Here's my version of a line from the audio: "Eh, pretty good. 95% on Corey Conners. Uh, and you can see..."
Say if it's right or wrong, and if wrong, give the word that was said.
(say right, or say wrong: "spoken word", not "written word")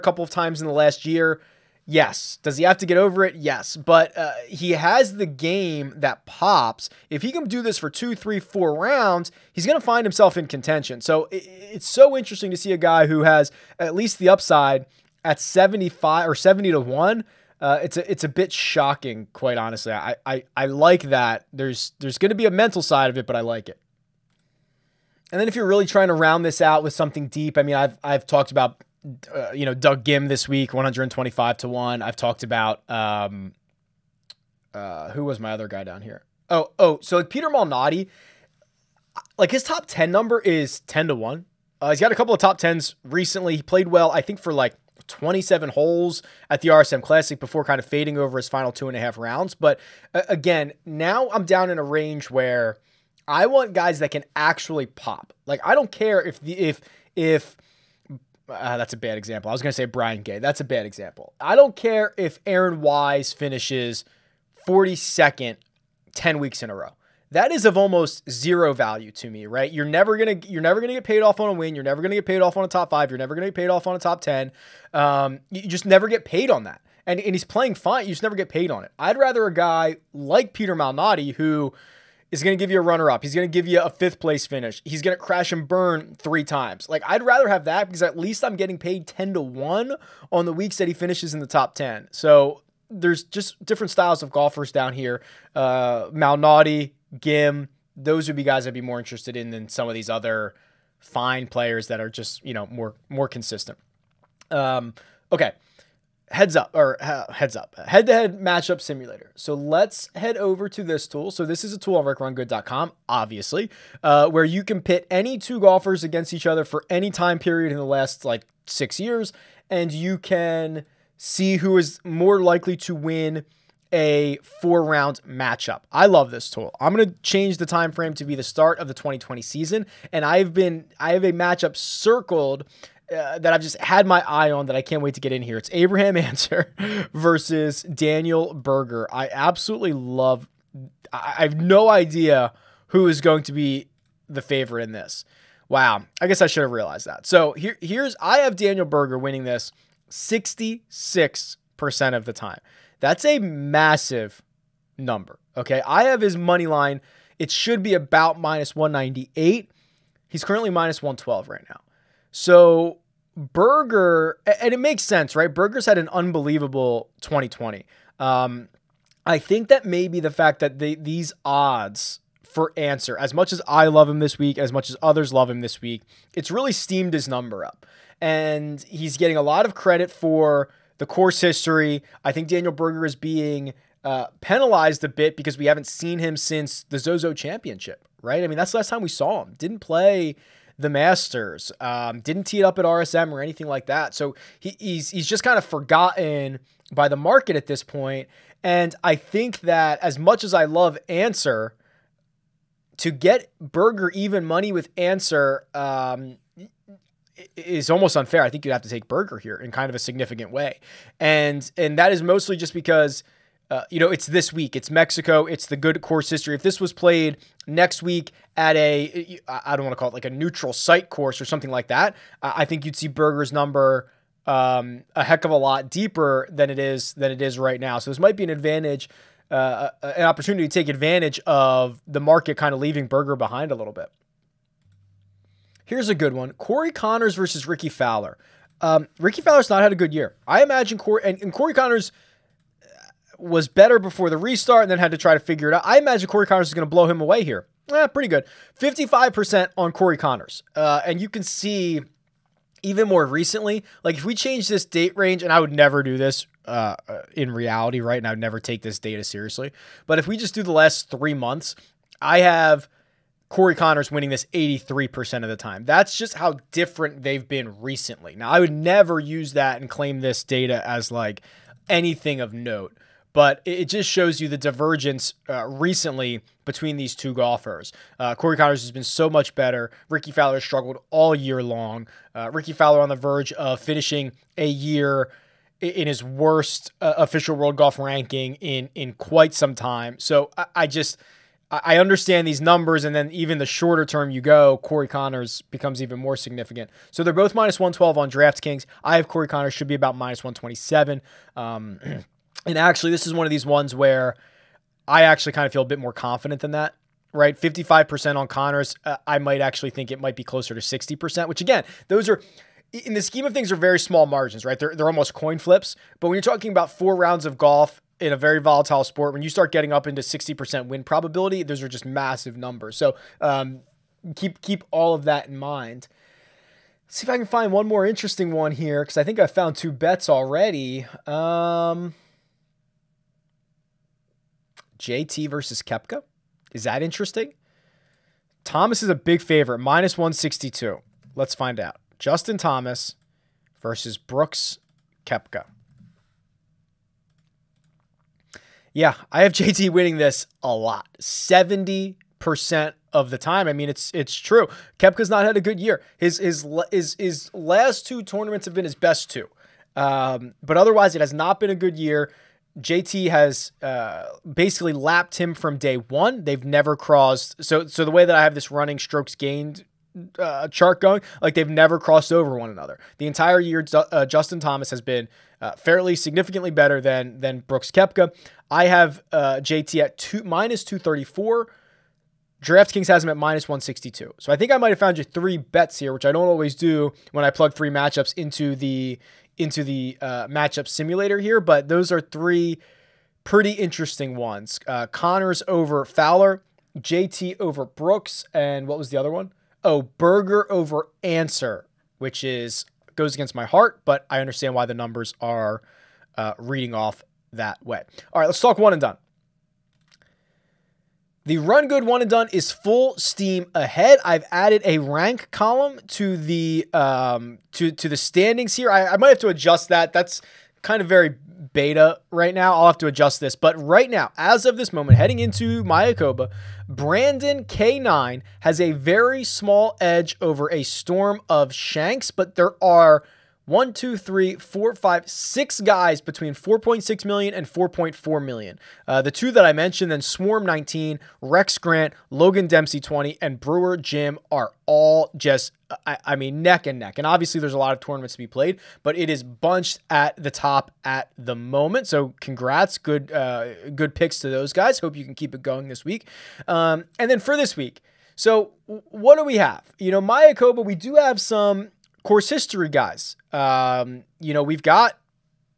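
wrong: "55", not "95".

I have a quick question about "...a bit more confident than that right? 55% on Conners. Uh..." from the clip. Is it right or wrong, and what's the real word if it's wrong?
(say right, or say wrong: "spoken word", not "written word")
right.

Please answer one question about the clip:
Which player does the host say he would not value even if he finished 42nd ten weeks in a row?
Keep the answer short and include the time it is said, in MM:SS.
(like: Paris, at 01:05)
Aaron Wise, at 01:02.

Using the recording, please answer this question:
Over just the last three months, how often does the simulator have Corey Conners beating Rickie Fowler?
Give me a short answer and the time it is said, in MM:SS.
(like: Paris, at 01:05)
83%, at 04:24.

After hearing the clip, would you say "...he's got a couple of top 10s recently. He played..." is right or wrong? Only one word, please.
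right.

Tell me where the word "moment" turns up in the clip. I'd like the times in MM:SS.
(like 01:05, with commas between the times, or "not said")
07:04, 07:31.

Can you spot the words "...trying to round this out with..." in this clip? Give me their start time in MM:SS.
00:25.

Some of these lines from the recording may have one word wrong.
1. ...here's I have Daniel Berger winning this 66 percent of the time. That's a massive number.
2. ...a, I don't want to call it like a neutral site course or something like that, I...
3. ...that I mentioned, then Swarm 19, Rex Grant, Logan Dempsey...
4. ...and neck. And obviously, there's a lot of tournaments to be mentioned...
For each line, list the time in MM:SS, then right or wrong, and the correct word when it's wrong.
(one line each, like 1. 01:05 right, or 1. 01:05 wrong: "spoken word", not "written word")
1. 02:27 right
2. 03:38 right
3. 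07:19 right
4. 07:26 wrong: "played", not "mentioned".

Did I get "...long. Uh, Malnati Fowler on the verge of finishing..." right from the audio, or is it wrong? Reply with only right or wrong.
wrong.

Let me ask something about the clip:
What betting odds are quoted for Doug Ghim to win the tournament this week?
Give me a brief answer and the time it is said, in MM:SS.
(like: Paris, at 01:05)
125 to 1, at 00:30.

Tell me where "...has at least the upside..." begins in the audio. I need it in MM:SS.
00:13.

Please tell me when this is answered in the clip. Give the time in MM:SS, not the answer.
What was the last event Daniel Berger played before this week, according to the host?
03:06.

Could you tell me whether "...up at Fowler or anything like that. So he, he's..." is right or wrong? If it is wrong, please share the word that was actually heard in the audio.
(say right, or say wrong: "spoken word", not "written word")
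wrong: "RSM", not "Fowler".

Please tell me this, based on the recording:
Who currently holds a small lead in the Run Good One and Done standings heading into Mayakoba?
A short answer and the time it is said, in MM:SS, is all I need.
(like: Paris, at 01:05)
Brandon K9, at 07:06.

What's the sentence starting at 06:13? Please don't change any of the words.
The entire year, uh, Justin Thomas has been uh, fairly significantly better than than Brooks Koepka.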